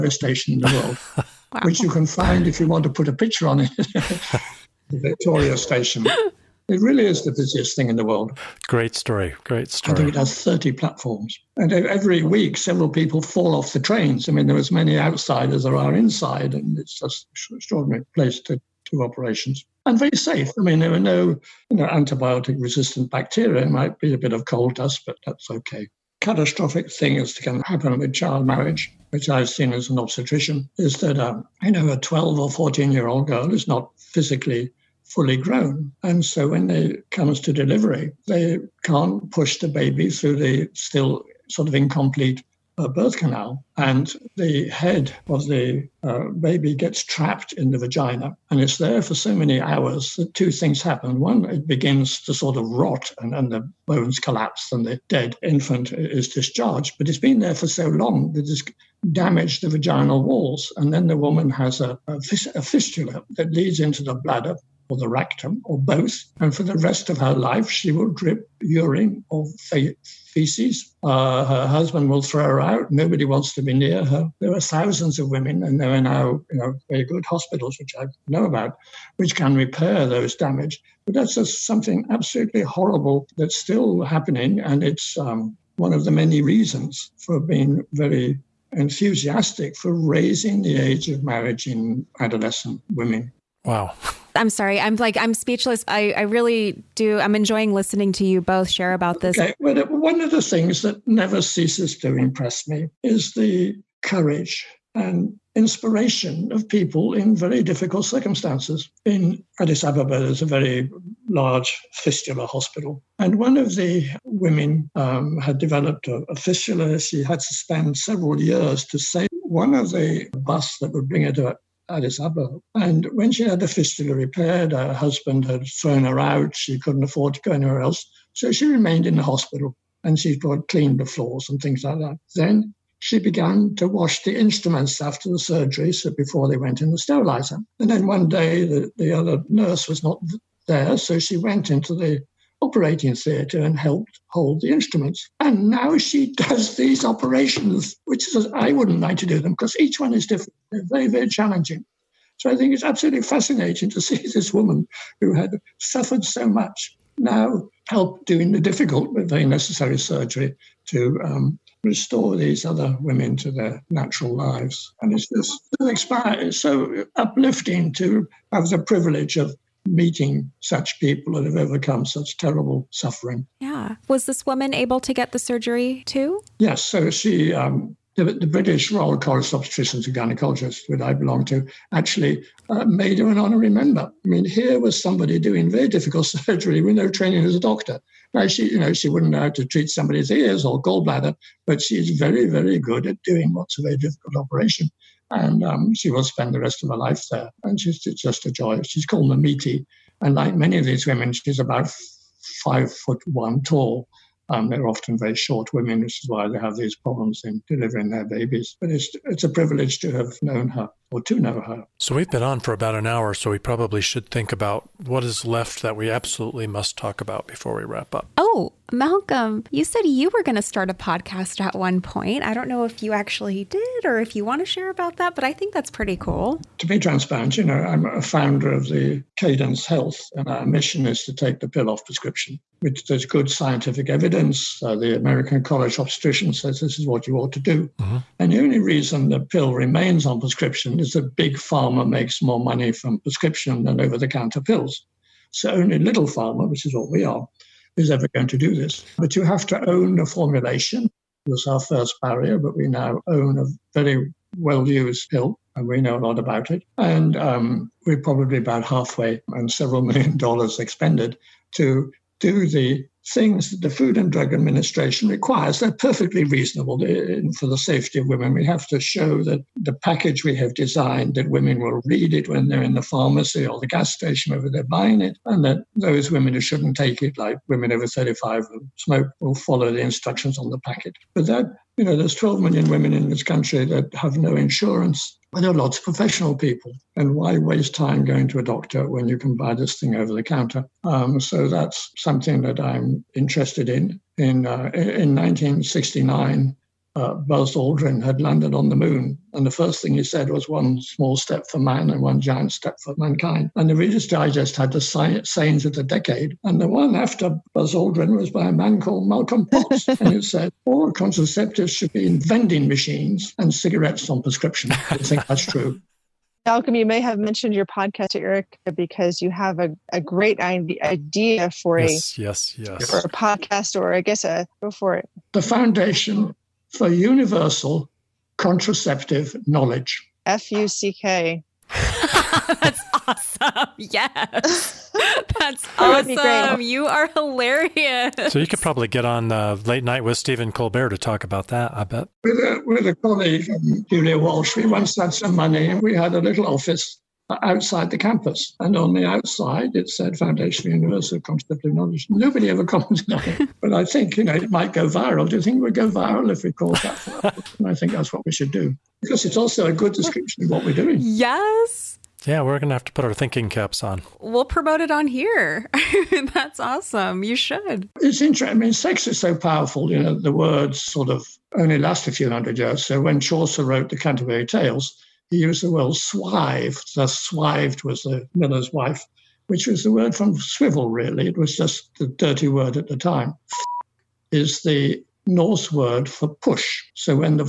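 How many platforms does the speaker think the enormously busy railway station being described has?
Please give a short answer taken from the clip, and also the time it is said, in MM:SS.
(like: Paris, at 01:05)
30, at 00:10.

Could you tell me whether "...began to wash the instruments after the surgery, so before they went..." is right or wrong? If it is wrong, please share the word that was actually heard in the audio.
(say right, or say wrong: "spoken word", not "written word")
right.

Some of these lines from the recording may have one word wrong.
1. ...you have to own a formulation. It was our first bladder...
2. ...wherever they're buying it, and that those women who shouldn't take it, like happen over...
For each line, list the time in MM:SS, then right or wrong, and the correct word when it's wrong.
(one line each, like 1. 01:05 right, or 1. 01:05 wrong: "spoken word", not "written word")
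1. 04:09 wrong: "barrier", not "bladder"
2. 04:34 wrong: "women", not "happen".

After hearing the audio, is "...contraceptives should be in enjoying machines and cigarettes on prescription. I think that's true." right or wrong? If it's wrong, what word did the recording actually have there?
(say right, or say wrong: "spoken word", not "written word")
wrong: "vending", not "enjoying".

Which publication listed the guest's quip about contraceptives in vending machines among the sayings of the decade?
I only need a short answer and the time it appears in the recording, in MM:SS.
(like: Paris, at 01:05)
Reader's Digest, at 05:03.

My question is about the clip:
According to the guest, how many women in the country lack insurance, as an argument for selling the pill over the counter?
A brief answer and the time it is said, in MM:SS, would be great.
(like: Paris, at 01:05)
12 million, at 04:42.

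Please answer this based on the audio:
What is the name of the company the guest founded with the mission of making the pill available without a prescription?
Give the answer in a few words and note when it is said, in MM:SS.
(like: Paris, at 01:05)
Cadence Health, at 03:49.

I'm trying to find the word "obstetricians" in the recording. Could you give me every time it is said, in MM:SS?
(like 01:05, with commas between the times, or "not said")
00:29, 02:59, 03:56.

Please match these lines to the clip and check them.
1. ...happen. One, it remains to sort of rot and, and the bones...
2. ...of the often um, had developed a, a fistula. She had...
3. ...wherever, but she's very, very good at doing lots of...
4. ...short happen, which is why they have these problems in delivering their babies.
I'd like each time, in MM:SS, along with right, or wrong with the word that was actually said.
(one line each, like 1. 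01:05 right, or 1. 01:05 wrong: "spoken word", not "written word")
1. 00:50 wrong: "begins", not "remains"
2. 01:53 wrong: "women", not "often"
3. 03:10 wrong: "gallbladder", not "wherever"
4. 03:25 wrong: "women", not "happen".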